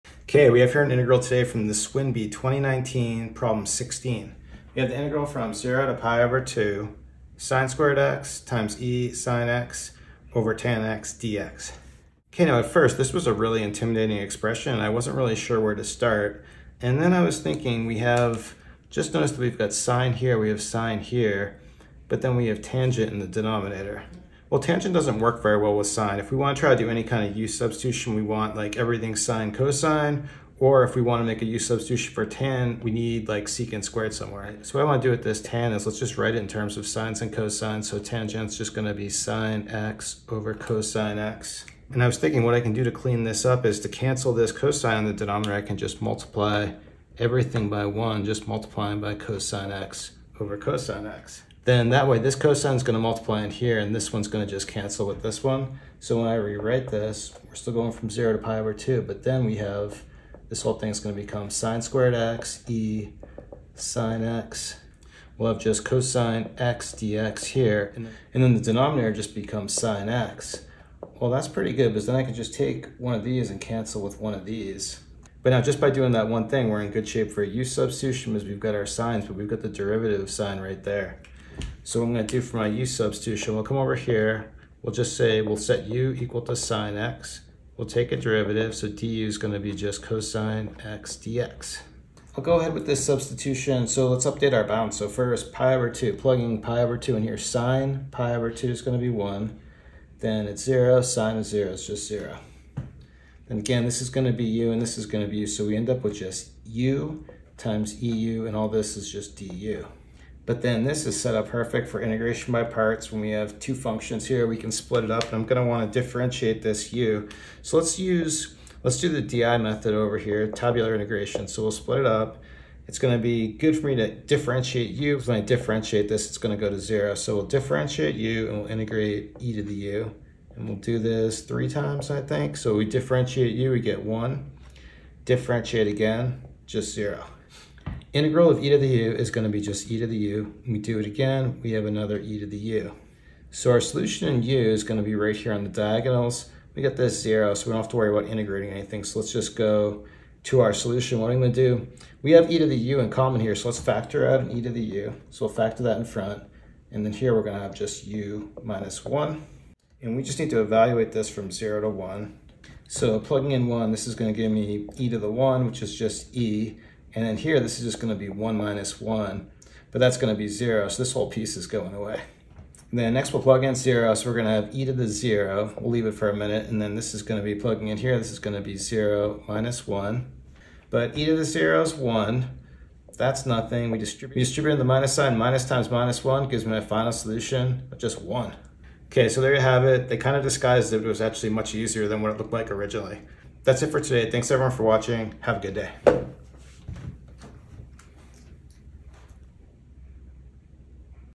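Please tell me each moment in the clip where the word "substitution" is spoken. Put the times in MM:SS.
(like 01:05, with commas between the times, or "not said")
00:27, 00:31, 01:17, 01:22, 01:33.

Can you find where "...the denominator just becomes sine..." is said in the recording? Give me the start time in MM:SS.
01:08.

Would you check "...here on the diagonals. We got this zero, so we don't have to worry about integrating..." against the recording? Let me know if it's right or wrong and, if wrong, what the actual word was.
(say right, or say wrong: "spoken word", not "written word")
right.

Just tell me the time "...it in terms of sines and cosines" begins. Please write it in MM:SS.
00:36.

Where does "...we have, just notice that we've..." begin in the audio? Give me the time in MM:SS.
00:17.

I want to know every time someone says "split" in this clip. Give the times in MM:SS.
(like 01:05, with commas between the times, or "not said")
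01:54, 02:01.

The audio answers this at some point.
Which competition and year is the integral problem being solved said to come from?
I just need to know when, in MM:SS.
00:01.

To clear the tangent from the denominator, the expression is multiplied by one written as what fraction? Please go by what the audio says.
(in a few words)
cosine x over cosine x.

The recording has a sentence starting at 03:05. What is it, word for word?
Minus times minus one gives me my final solution of just one.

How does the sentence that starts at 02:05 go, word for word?
When I differentiate this, it's gonna to go to zero.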